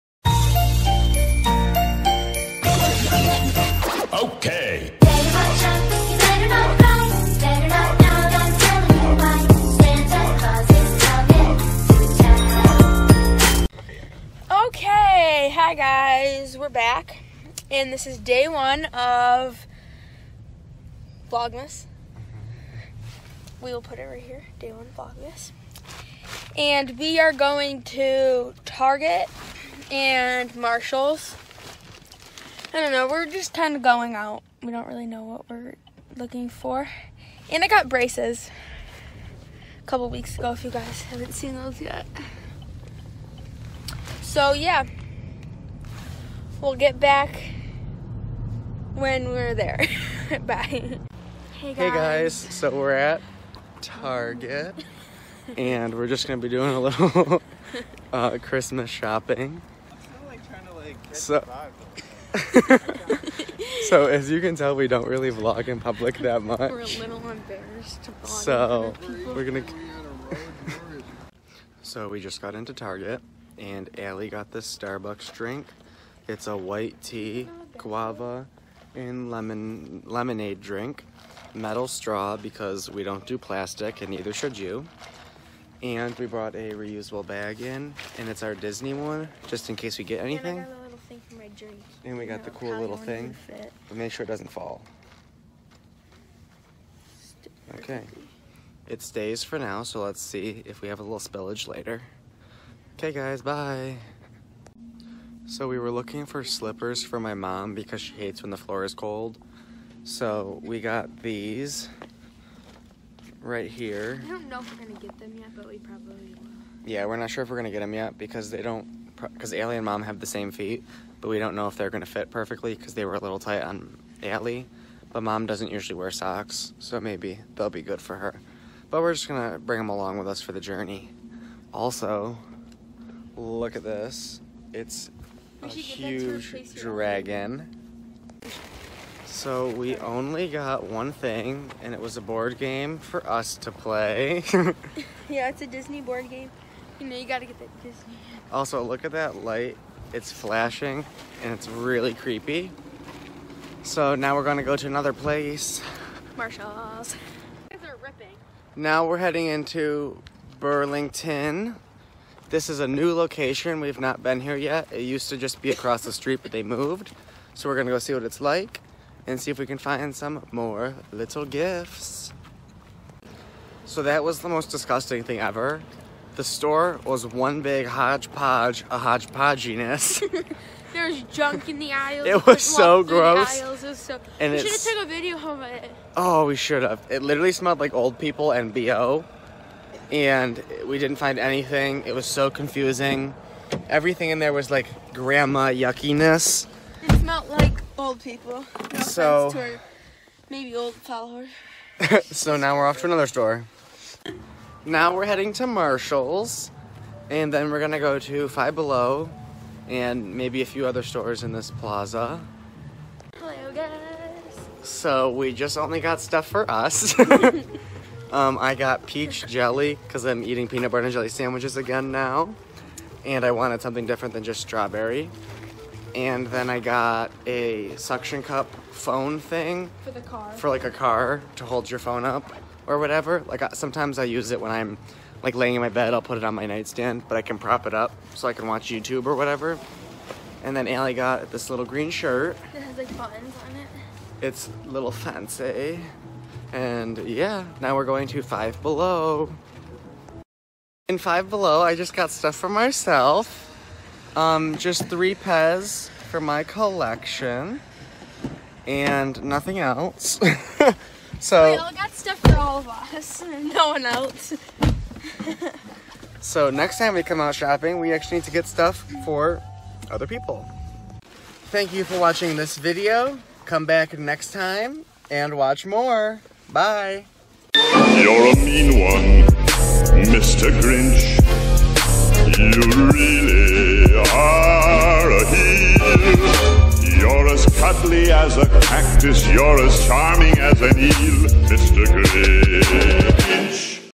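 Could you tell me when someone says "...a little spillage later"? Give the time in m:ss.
1:40.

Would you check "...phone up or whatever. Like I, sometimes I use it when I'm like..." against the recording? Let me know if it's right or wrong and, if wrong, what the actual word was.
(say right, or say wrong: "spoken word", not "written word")
right.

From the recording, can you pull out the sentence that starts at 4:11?
In Five Below, I just got stuff for myself.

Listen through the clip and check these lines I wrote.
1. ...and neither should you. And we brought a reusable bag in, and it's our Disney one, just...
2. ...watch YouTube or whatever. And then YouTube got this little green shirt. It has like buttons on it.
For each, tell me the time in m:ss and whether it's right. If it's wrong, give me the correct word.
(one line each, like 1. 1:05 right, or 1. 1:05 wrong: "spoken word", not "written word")
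1. 1:24 right
2. 3:58 wrong: "Allie", not "YouTube".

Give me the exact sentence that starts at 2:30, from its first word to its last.
It's flashing and it's really creepy.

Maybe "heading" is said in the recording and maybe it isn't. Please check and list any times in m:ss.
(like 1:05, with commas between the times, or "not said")
2:39, 3:25.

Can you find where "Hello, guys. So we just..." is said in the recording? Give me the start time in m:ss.
3:33.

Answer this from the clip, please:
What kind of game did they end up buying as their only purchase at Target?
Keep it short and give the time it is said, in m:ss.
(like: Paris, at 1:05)
Disney board game, at 2:25.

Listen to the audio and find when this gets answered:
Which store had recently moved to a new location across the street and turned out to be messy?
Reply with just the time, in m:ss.
2:40.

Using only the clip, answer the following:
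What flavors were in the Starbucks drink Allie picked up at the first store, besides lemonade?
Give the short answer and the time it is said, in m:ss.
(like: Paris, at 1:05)
white tea, guava, at 1:16.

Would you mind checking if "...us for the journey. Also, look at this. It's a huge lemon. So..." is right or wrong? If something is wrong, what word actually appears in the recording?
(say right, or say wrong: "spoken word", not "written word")
wrong: "dragon", not "lemon".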